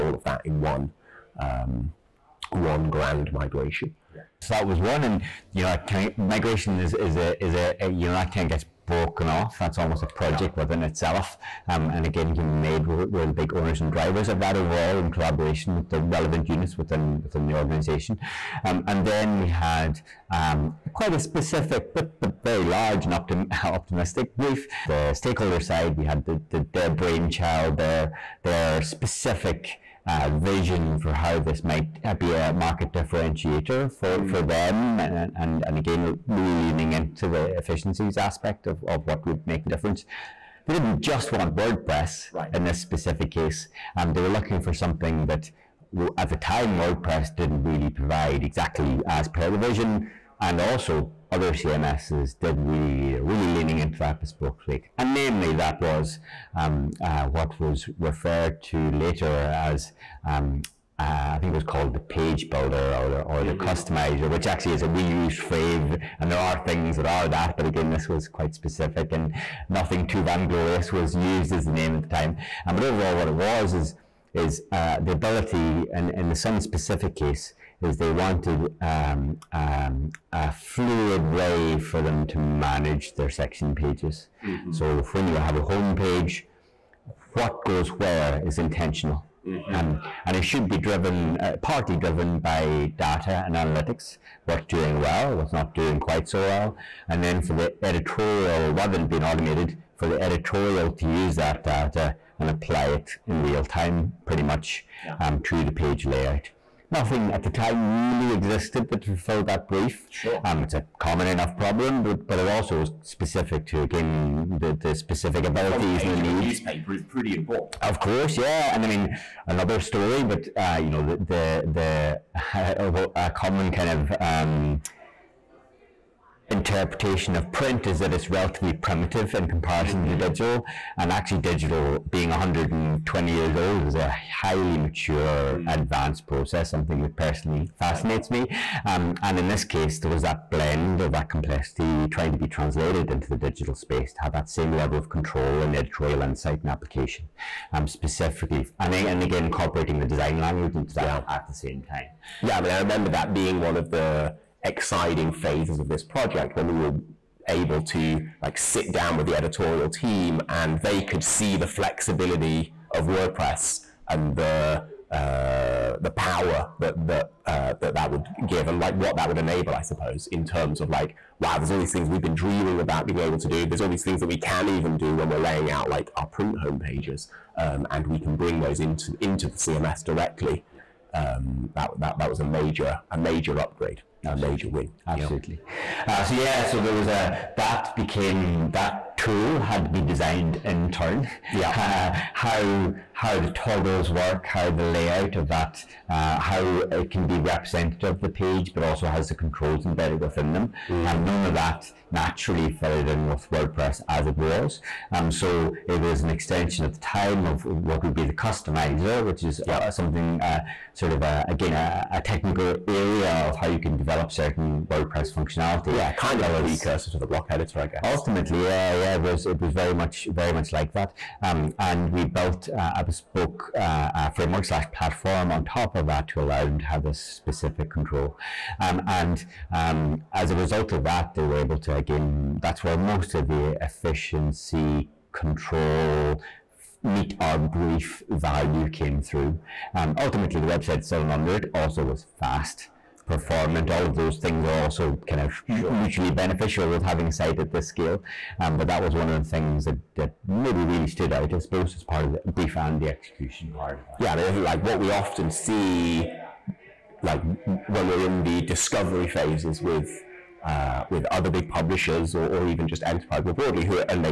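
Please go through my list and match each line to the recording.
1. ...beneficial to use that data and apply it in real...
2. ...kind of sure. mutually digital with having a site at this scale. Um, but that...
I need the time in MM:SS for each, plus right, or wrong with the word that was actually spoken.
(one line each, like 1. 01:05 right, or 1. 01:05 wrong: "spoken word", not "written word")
1. 01:40 wrong: "editorial", not "beneficial"
2. 04:05 wrong: "beneficial", not "digital".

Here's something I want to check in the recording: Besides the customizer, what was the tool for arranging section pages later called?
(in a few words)
page builder.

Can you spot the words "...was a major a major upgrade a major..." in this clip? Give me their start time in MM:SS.
03:02.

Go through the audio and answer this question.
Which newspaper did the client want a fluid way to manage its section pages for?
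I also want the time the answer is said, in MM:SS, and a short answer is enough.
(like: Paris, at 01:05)
The Sun, at 01:16.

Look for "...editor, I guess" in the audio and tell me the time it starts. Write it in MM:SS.
03:37.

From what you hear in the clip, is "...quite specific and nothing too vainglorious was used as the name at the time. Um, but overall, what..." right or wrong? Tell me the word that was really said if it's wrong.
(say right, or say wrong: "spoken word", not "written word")
right.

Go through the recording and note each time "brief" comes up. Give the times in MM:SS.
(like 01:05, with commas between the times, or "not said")
00:24, 01:49, 03:57, 04:12.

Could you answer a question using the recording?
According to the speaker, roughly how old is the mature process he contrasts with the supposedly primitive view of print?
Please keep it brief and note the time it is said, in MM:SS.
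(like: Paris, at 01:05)
120, at 02:12.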